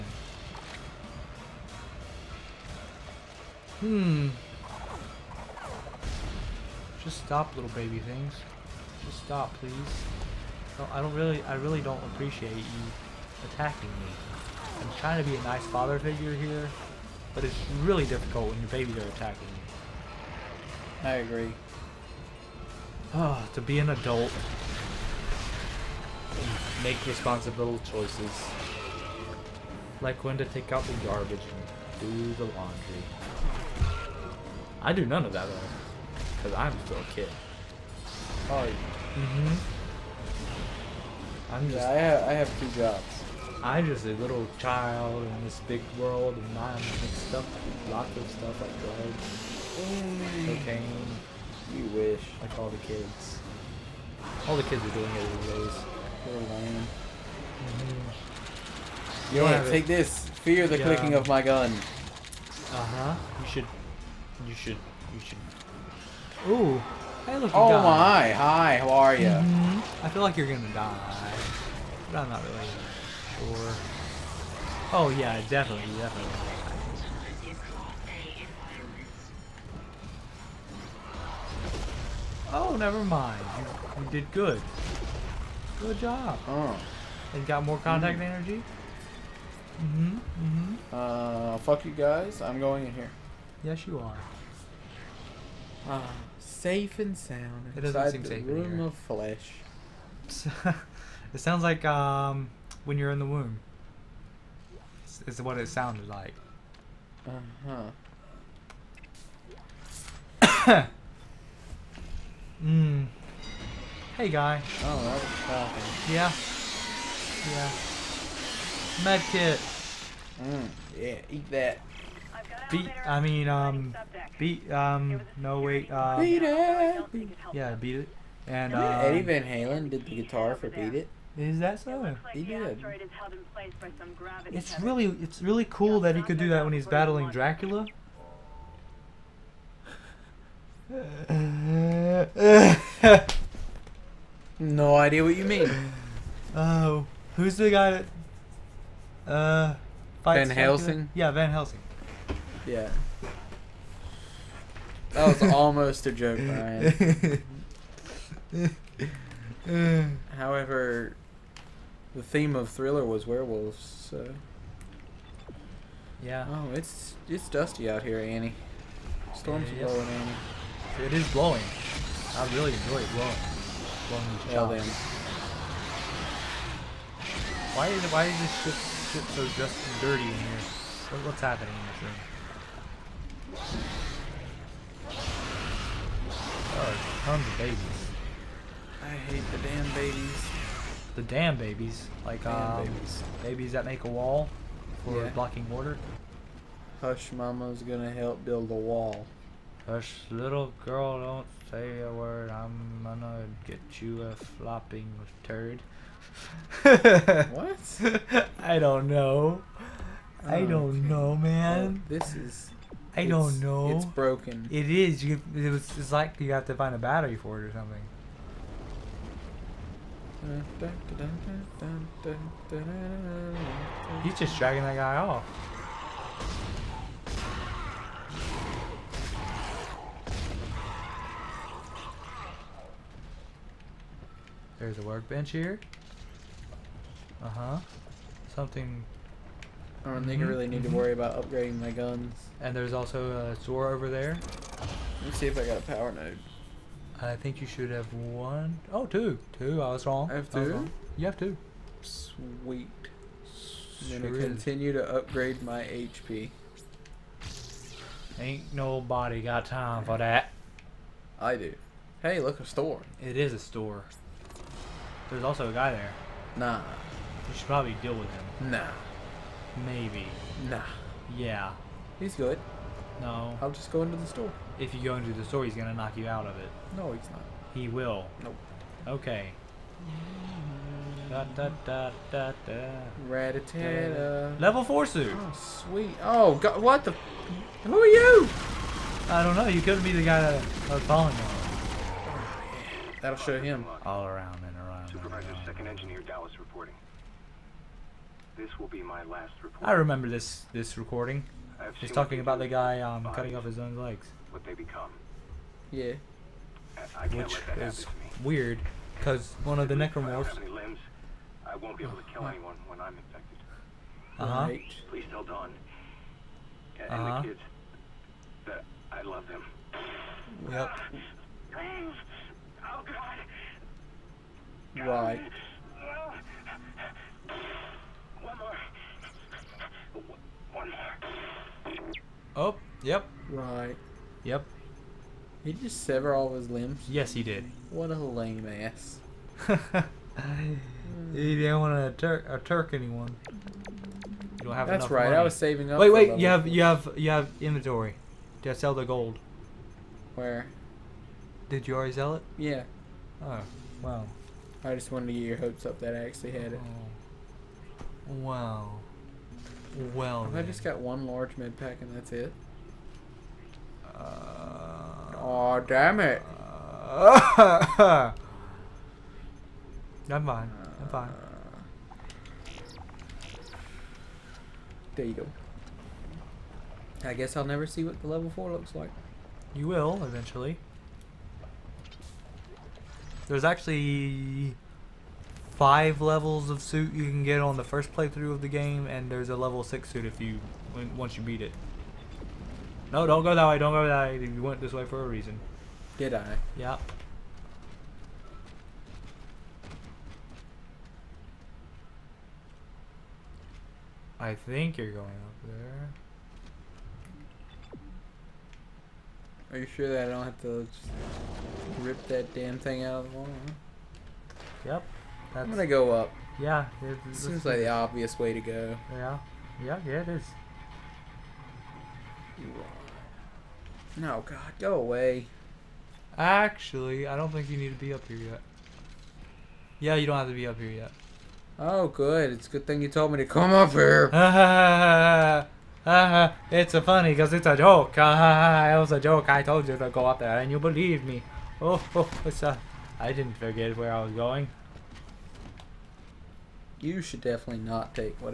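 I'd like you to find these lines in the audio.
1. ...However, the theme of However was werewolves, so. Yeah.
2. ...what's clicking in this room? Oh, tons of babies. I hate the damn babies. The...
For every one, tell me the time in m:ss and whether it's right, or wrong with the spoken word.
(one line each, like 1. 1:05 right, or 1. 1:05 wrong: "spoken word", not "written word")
1. 2:40 wrong: "Thriller", not "However"
2. 3:01 wrong: "happening", not "clicking".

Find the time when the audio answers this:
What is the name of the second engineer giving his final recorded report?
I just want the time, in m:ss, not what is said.
4:56.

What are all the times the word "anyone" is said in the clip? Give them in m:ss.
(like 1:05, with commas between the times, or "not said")
5:12, 5:42.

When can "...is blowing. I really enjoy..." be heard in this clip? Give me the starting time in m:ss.
2:51.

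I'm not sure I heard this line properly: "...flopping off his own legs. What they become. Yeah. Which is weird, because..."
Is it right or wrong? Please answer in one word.
wrong.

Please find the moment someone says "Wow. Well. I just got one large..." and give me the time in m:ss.
5:58.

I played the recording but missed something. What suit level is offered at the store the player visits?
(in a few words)
Level 4.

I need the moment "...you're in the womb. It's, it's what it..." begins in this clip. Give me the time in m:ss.
1:42.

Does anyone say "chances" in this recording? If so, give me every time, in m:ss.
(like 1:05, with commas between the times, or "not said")
not said.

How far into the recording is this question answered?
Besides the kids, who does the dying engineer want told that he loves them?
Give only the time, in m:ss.
5:15.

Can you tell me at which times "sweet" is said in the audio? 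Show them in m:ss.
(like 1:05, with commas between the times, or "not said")
4:12, 4:45.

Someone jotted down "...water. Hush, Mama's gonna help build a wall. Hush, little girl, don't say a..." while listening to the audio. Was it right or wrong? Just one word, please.
right.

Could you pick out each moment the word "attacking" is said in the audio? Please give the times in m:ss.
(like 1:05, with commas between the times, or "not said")
0:13, 0:19.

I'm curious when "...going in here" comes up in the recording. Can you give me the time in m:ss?
1:32.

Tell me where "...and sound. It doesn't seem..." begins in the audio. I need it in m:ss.
1:37.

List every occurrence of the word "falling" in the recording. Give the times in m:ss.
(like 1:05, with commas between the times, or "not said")
4:51.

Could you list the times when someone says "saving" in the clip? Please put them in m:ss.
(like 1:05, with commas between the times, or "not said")
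5:45.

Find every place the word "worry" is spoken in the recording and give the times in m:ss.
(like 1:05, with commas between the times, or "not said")
4:00.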